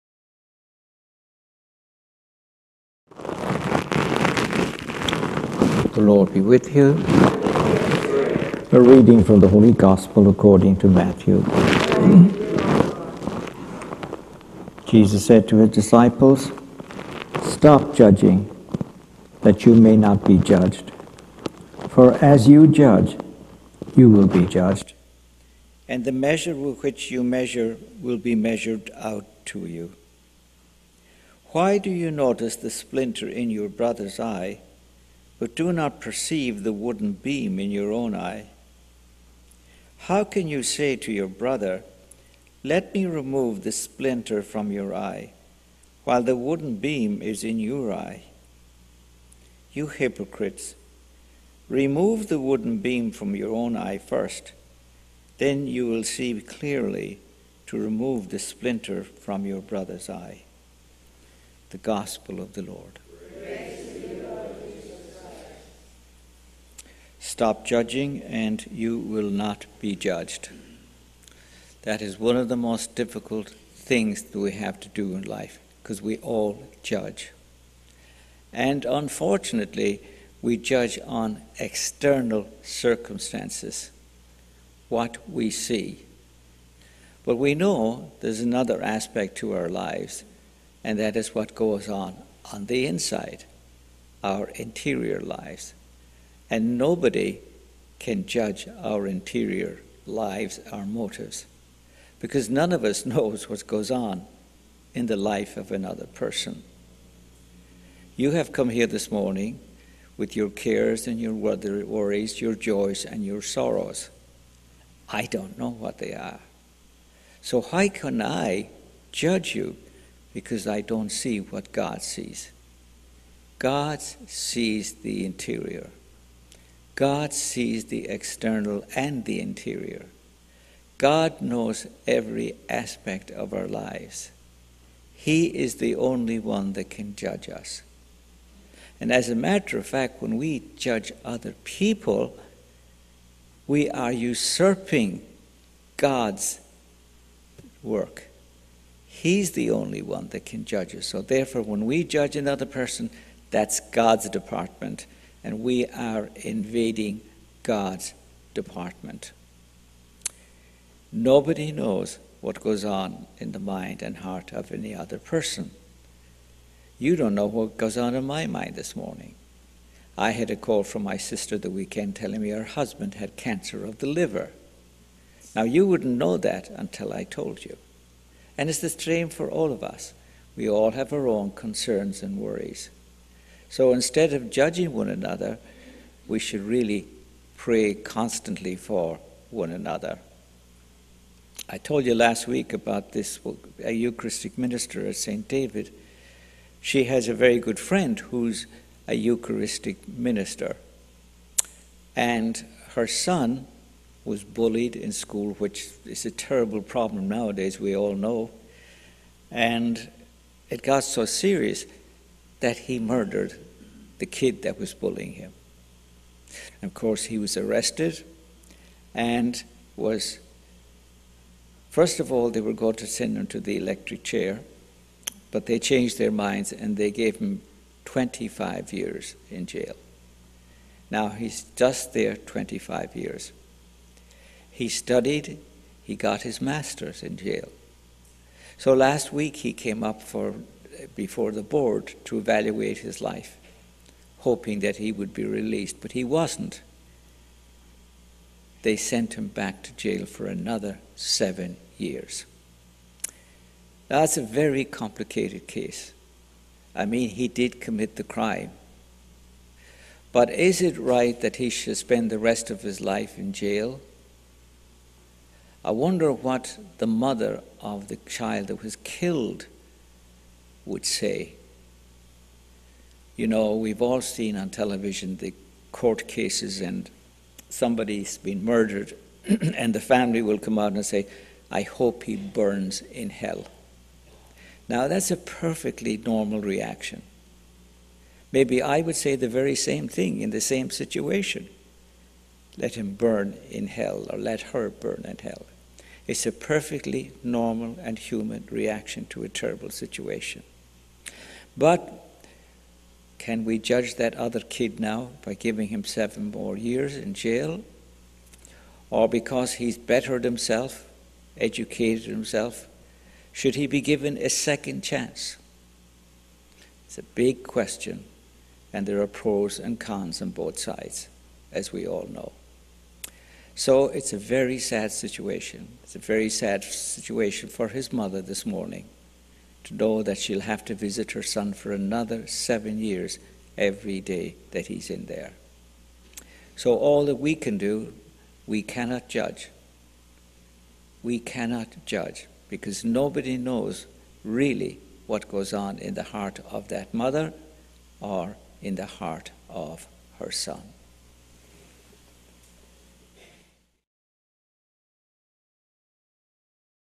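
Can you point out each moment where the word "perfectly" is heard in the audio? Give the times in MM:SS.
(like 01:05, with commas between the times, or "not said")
04:45, 04:56.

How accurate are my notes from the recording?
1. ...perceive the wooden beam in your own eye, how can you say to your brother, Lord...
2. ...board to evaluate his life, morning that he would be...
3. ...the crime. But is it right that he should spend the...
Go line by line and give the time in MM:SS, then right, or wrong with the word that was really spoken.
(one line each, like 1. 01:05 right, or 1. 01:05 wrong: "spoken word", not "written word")
1. 00:35 wrong: "Let", not "Lord"
2. 04:01 wrong: "hoping", not "morning"
3. 04:18 right.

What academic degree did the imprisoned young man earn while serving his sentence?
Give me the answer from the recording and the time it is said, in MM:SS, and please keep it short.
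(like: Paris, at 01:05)
Master's, at 03:56.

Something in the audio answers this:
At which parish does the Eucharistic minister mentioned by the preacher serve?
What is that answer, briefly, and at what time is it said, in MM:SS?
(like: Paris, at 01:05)
St. David, at 03:15.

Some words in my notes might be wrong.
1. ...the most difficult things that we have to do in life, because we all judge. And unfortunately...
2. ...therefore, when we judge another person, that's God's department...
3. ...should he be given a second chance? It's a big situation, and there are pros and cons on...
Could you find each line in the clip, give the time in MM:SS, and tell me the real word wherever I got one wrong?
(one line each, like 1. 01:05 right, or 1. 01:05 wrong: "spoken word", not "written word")
1. 01:12 right
2. 02:31 right
3. 05:13 wrong: "question", not "situation".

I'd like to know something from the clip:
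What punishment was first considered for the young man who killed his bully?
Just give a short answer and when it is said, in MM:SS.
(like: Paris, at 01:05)
Electric chair, at 03:43.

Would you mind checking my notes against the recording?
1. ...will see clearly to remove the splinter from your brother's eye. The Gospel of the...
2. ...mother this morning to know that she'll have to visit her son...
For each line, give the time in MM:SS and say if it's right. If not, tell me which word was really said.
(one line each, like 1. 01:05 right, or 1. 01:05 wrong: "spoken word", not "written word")
1. 00:55 right
2. 05:28 right.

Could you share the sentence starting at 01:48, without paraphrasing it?
You have come here this morning with your cares and your worries, your joys and your sorrows.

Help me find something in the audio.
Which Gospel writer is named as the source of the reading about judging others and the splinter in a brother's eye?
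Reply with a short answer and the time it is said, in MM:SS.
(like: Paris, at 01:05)
Matthew, at 00:10.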